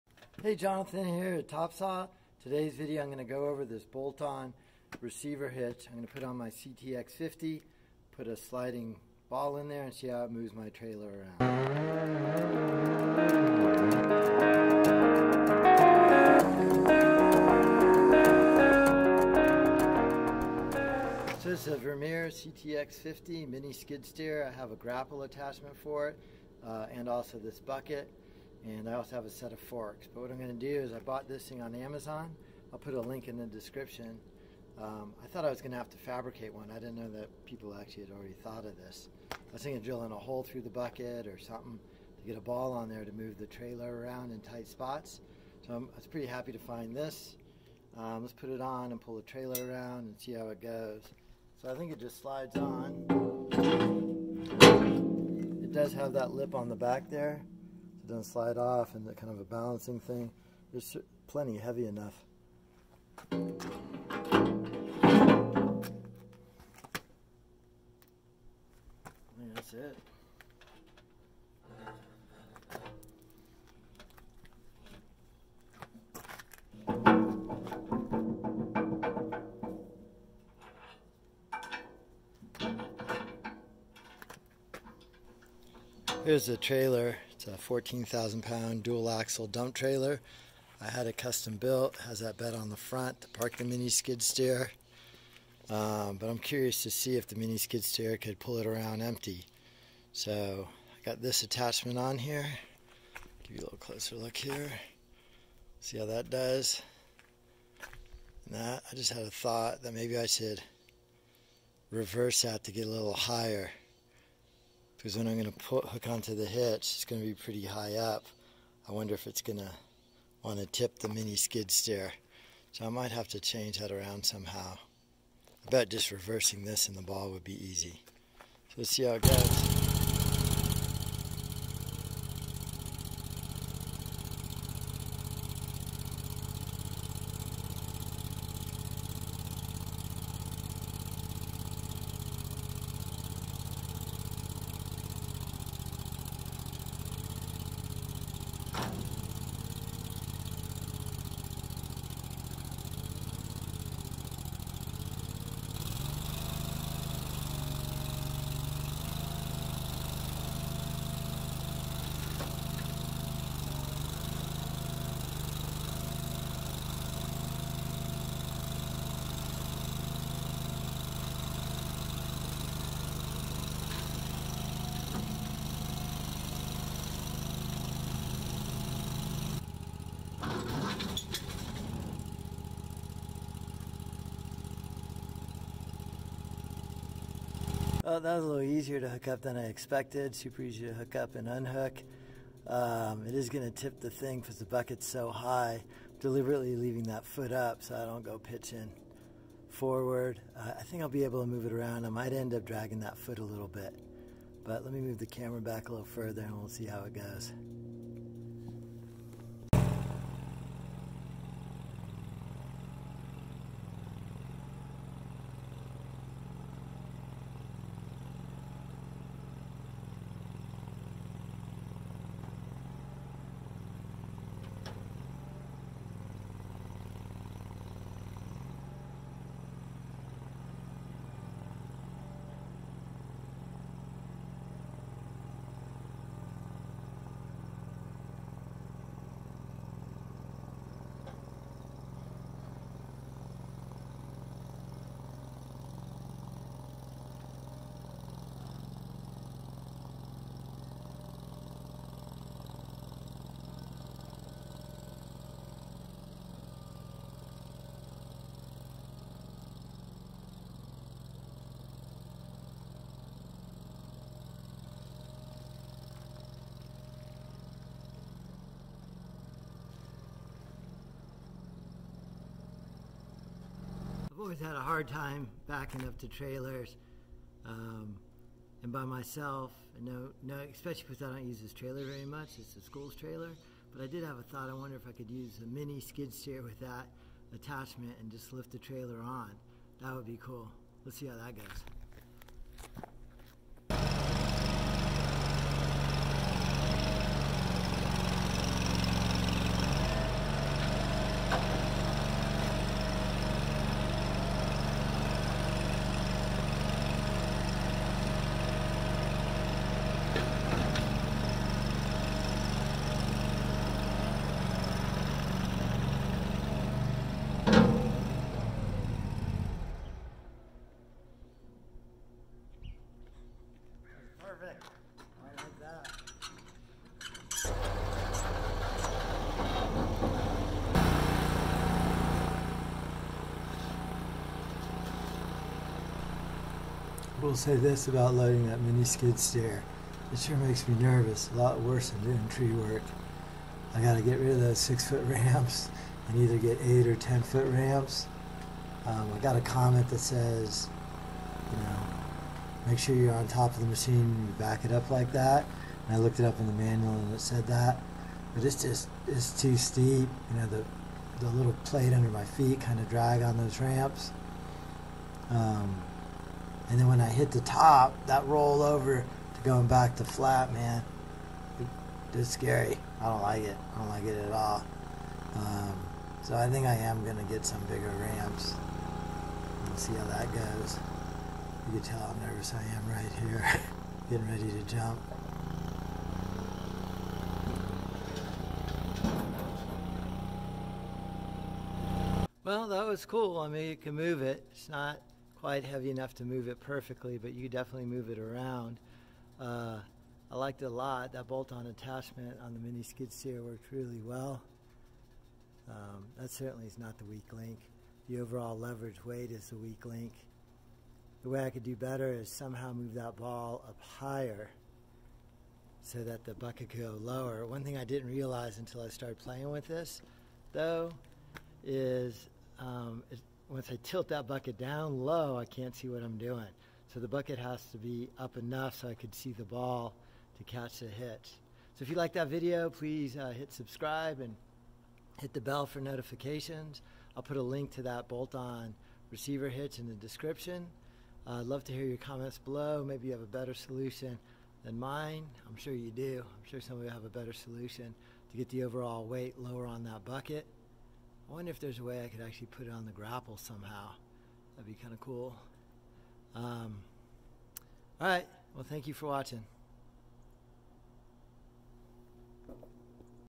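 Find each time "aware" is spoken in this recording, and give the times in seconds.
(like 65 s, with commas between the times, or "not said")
not said.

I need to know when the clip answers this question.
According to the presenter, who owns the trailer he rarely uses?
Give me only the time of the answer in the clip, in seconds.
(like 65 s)
282 s.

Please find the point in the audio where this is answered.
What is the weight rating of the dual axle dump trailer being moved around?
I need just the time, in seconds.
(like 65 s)
87 s.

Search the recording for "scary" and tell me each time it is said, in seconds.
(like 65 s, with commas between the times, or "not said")
372 s.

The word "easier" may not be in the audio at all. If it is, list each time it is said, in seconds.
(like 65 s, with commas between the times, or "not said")
188 s.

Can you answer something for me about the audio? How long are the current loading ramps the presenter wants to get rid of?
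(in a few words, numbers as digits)
6 feet.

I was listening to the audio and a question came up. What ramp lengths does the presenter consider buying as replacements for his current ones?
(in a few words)
8 or 10 feet.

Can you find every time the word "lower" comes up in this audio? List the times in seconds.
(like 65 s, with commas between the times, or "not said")
417 s, 449 s.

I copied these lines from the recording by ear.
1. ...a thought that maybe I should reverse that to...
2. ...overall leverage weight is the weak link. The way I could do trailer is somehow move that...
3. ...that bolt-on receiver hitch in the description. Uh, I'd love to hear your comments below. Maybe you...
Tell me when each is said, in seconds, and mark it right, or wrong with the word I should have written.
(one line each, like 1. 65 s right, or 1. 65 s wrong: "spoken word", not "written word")
1. 109 s right
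2. 408 s wrong: "better", not "trailer"
3. 438 s right.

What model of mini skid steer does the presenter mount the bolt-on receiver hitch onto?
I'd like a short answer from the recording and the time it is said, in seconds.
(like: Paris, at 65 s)
Vermeer CTX50, at 21 s.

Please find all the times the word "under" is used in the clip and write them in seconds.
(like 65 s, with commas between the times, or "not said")
362 s.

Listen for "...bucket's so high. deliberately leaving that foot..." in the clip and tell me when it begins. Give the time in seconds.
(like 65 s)
194 s.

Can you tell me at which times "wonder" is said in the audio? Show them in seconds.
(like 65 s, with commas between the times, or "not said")
118 s, 284 s, 451 s.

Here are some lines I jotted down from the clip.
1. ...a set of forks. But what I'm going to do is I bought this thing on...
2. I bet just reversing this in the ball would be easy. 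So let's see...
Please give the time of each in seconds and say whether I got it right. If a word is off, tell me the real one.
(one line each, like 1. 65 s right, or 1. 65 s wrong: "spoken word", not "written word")
1. 29 s right
2. 124 s right.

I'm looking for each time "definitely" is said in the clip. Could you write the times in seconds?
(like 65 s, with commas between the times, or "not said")
397 s.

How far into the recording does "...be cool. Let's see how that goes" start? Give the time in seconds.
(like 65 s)
290 s.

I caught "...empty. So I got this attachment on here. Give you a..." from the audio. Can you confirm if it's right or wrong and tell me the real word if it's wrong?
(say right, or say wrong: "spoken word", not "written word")
right.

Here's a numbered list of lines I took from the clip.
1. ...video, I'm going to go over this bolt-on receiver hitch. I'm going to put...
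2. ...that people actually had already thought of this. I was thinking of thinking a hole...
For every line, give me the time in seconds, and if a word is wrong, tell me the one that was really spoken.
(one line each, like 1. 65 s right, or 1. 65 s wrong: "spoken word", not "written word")
1. 2 s right
2. 37 s wrong: "drilling", not "thinking".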